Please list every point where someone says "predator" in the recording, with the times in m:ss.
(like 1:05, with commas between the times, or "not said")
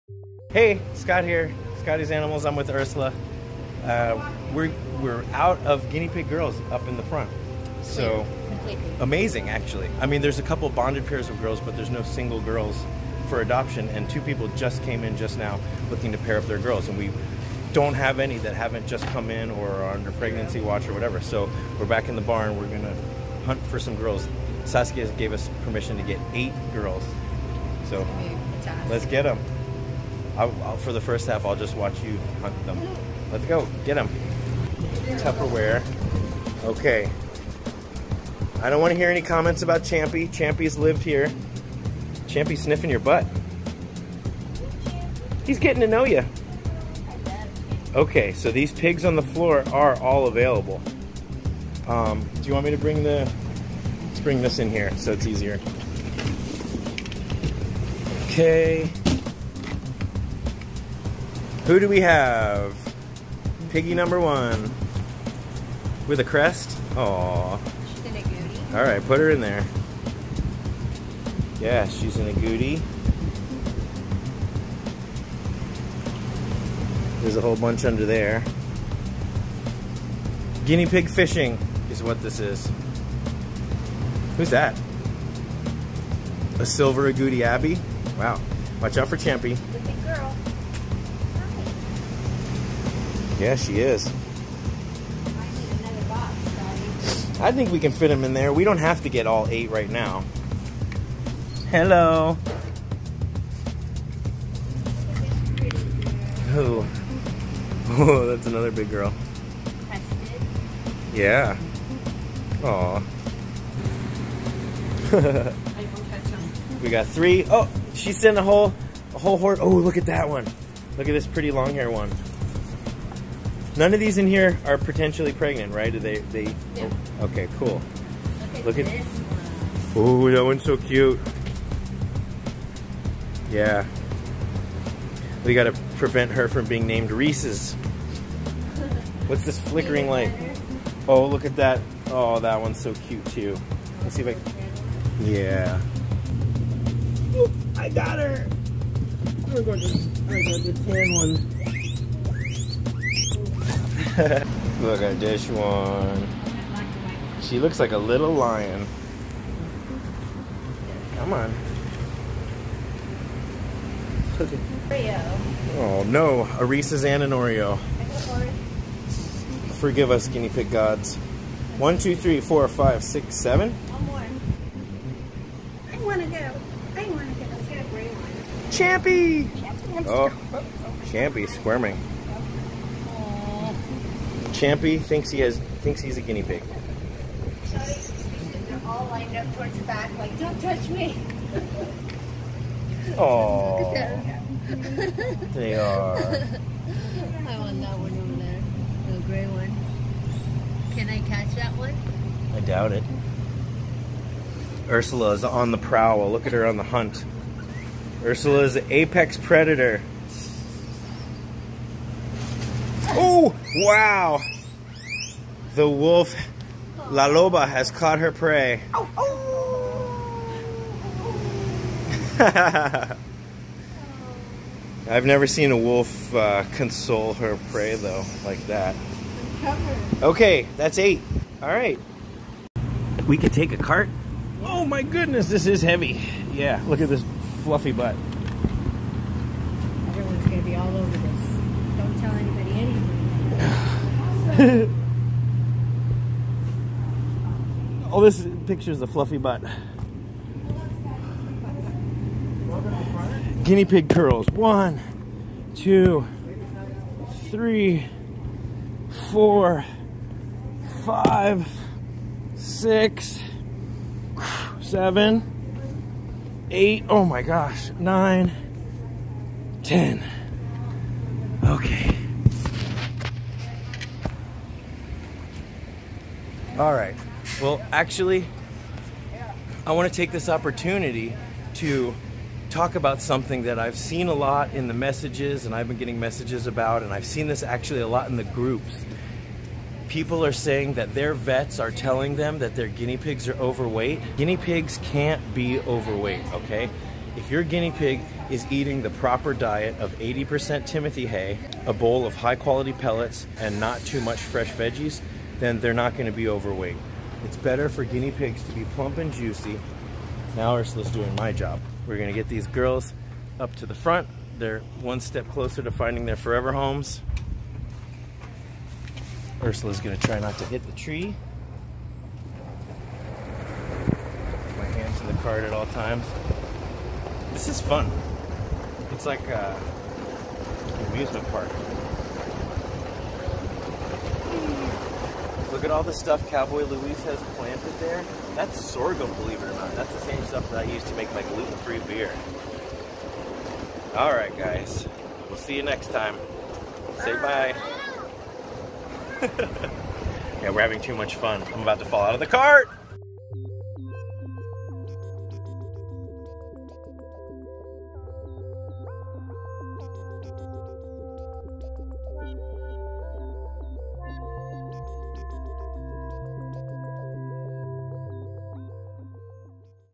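3:29.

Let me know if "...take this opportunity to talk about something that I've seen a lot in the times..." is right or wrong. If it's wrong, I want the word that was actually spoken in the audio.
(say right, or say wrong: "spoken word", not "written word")
wrong: "messages", not "times".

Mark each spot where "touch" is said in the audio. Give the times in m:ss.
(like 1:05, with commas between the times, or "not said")
3:10.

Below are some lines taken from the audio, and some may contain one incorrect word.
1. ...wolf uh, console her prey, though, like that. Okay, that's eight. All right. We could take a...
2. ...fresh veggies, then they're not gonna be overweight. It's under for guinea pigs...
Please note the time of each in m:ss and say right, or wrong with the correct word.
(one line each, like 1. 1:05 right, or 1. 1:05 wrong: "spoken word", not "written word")
1. 3:45 right
2. 5:04 wrong: "better", not "under".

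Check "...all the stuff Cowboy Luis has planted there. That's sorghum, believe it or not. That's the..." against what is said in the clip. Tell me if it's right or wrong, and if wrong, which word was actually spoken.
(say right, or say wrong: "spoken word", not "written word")
right.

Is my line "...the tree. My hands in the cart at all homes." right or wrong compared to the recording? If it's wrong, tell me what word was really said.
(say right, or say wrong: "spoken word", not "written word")
wrong: "times", not "homes".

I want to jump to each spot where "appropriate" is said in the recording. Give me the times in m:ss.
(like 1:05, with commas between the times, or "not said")
not said.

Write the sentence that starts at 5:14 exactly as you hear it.
They're one step closer to finding their forever homes.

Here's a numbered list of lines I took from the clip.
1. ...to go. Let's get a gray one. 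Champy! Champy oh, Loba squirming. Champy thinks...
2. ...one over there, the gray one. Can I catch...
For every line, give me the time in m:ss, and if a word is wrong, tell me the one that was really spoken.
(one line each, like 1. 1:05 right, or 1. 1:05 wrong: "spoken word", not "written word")
1. 2:57 wrong: "Champy", not "Loba"
2. 3:17 right.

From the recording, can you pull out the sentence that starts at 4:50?
People are saying that their vets are telling them that their guinea pigs are overweight.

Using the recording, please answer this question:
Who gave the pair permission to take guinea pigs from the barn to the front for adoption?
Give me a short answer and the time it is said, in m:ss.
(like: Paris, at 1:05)
Saskia, at 0:24.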